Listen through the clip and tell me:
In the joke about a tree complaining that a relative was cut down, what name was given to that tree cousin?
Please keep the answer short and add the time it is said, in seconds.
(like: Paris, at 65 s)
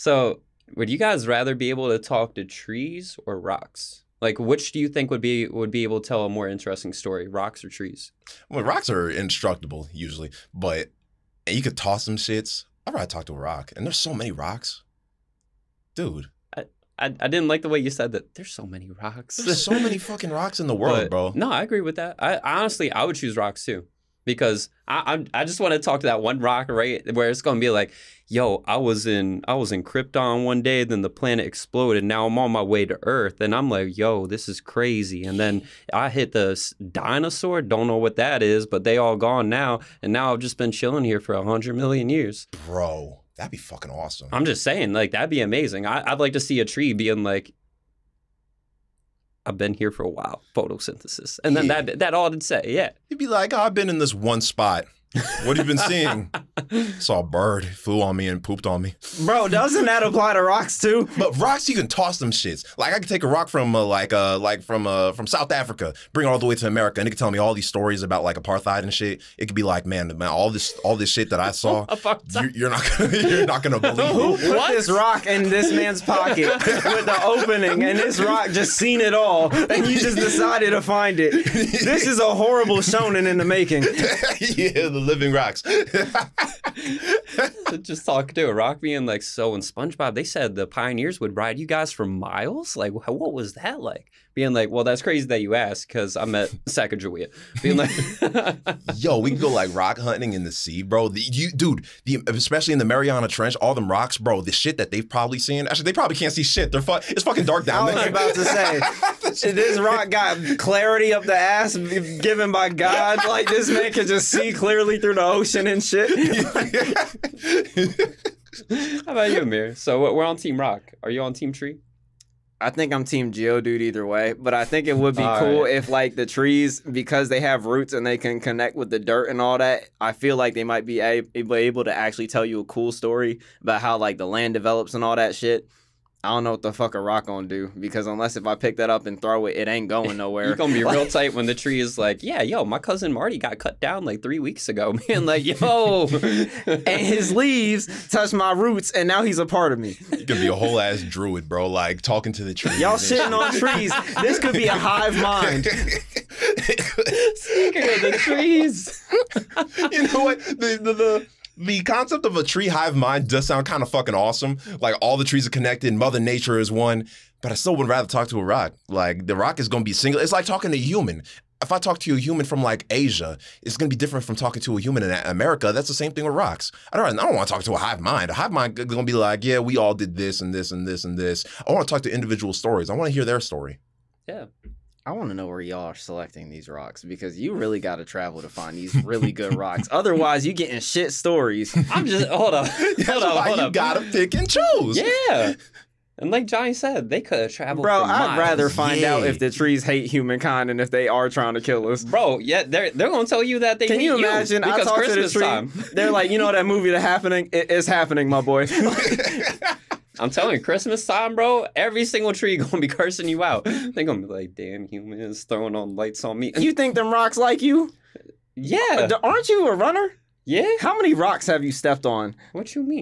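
Marty, at 143 s.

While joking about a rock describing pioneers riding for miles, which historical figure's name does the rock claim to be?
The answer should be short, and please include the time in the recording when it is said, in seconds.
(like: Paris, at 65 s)
Sacagawea, at 96 s.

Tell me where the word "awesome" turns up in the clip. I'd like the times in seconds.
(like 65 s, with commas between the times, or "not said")
43 s, 164 s.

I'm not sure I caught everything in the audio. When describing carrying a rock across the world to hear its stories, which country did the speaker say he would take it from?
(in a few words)
South Africa.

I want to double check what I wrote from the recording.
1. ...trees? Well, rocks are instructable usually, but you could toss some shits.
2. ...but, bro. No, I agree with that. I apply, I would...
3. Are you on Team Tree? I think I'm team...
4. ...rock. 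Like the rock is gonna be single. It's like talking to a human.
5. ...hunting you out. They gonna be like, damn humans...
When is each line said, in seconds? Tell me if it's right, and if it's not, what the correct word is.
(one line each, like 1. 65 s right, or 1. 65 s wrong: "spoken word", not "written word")
1. 7 s right
2. 20 s wrong: "honestly", not "apply"
3. 121 s right
4. 168 s right
5. 212 s wrong: "cursing", not "hunting".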